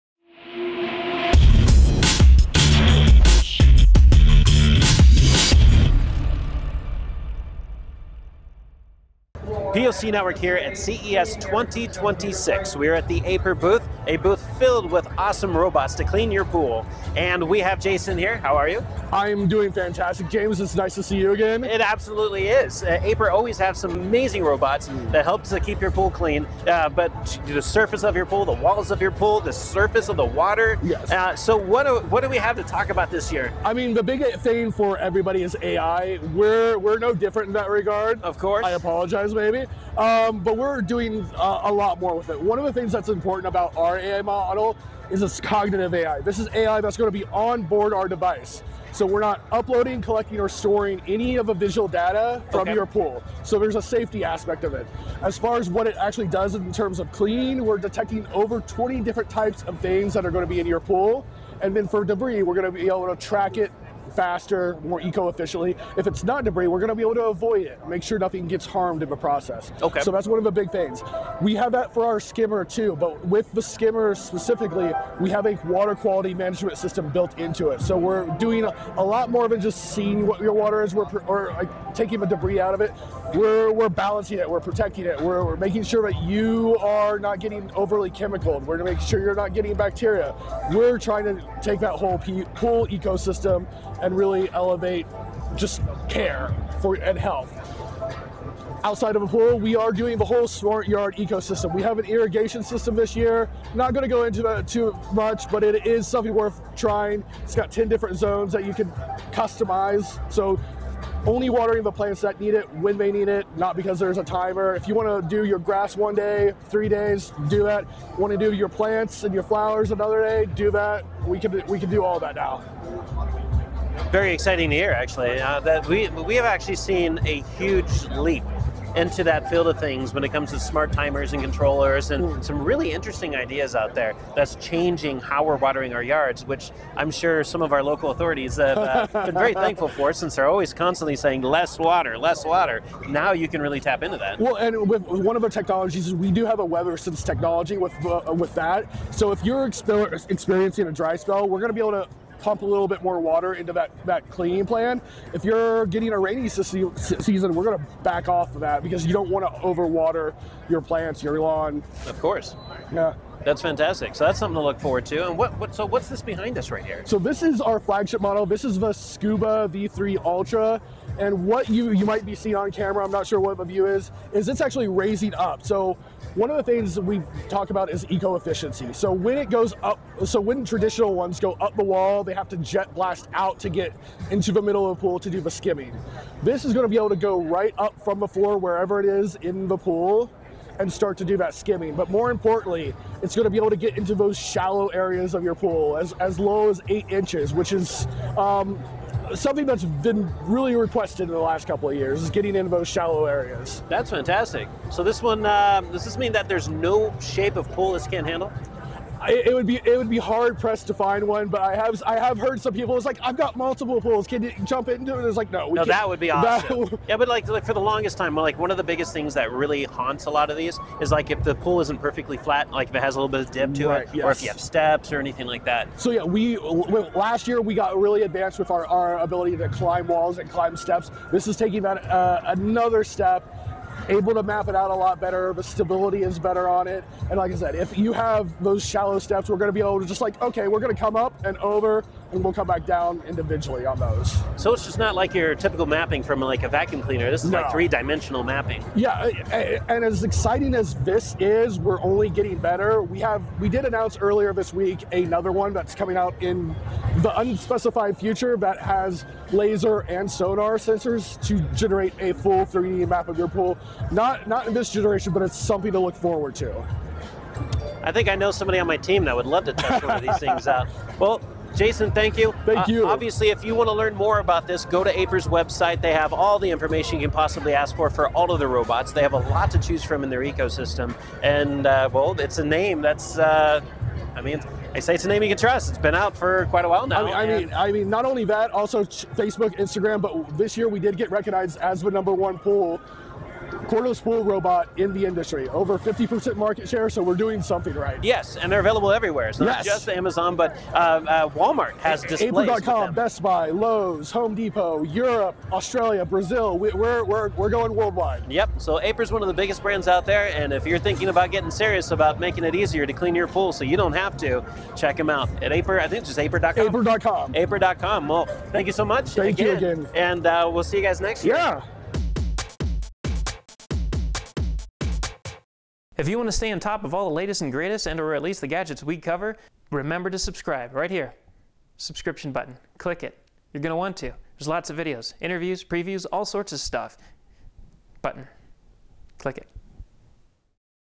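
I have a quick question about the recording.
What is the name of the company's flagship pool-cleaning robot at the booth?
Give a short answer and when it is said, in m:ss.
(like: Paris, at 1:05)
Scooba V3 Ultra, at 2:48.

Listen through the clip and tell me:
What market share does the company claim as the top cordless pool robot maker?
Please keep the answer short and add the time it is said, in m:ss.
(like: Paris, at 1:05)
over 50%, at 4:55.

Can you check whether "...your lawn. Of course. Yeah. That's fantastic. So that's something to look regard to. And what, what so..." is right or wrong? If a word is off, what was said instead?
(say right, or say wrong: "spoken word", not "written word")
wrong: "forward", not "regard".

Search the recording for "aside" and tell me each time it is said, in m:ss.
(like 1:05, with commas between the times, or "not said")
not said.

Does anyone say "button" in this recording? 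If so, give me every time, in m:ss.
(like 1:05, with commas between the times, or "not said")
5:32, 5:38.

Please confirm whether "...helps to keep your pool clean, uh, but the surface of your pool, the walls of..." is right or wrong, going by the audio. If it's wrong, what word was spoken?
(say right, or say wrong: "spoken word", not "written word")
right.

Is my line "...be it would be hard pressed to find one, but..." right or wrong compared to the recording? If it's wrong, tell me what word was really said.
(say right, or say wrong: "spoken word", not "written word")
right.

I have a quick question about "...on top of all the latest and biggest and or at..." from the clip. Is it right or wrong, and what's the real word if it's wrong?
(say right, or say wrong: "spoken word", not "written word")
wrong: "greatest", not "biggest".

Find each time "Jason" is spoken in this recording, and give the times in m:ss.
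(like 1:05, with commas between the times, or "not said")
0:17, 4:31.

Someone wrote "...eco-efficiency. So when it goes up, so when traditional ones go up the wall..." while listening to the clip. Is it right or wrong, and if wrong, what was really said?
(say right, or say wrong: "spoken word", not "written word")
right.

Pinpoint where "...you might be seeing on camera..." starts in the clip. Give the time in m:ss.
2:51.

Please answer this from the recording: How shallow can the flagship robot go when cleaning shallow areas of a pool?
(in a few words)
8 inches.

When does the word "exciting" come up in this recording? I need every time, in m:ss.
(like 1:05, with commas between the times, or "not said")
2:04, 4:10.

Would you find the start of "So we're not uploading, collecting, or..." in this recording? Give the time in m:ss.
0:48.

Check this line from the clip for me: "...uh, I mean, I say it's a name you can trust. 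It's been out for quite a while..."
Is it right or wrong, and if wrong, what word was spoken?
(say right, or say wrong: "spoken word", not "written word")
right.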